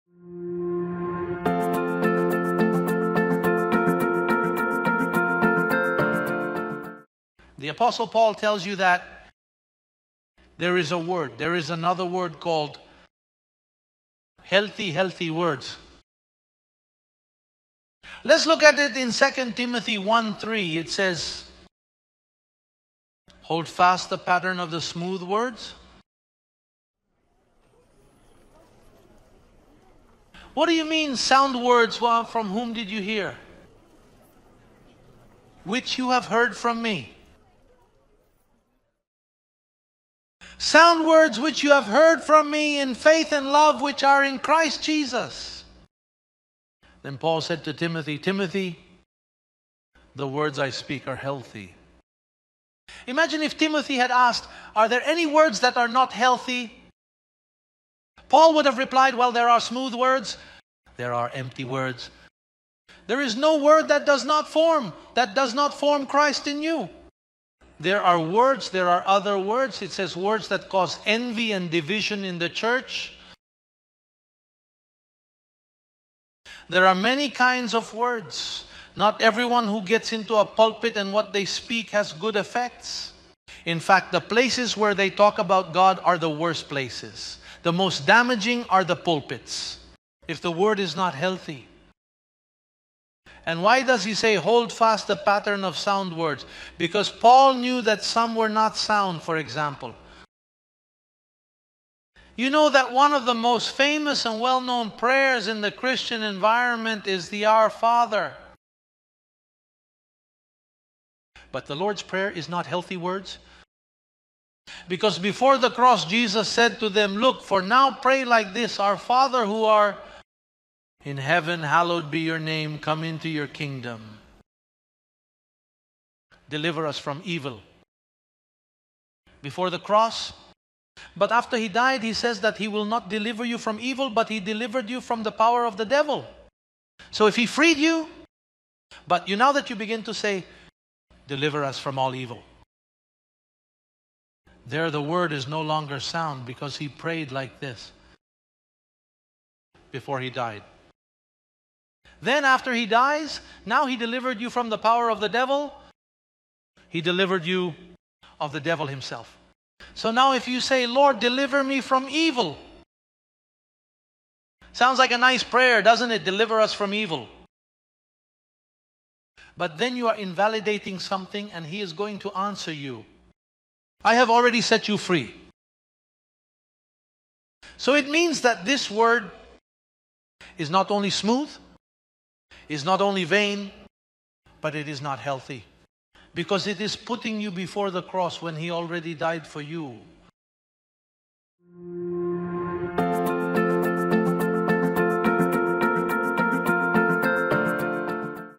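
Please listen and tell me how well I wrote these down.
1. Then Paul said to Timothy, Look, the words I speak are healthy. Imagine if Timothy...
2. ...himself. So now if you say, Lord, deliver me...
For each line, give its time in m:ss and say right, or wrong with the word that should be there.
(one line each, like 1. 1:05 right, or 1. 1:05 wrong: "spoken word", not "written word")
1. 0:47 wrong: "Timothy", not "Look"
2. 2:38 right.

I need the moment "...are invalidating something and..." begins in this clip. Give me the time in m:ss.
2:50.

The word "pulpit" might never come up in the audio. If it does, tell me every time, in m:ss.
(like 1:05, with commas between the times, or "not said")
1:20, 1:28.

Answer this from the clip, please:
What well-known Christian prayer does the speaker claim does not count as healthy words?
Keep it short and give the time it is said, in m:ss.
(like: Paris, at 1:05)
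The Lord's Prayer, at 1:51.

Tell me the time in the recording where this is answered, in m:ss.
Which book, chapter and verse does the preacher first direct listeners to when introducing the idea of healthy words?
0:19.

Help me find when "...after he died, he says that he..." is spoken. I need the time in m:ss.
2:11.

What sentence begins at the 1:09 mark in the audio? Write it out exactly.
It says words that cause envy and division in the church.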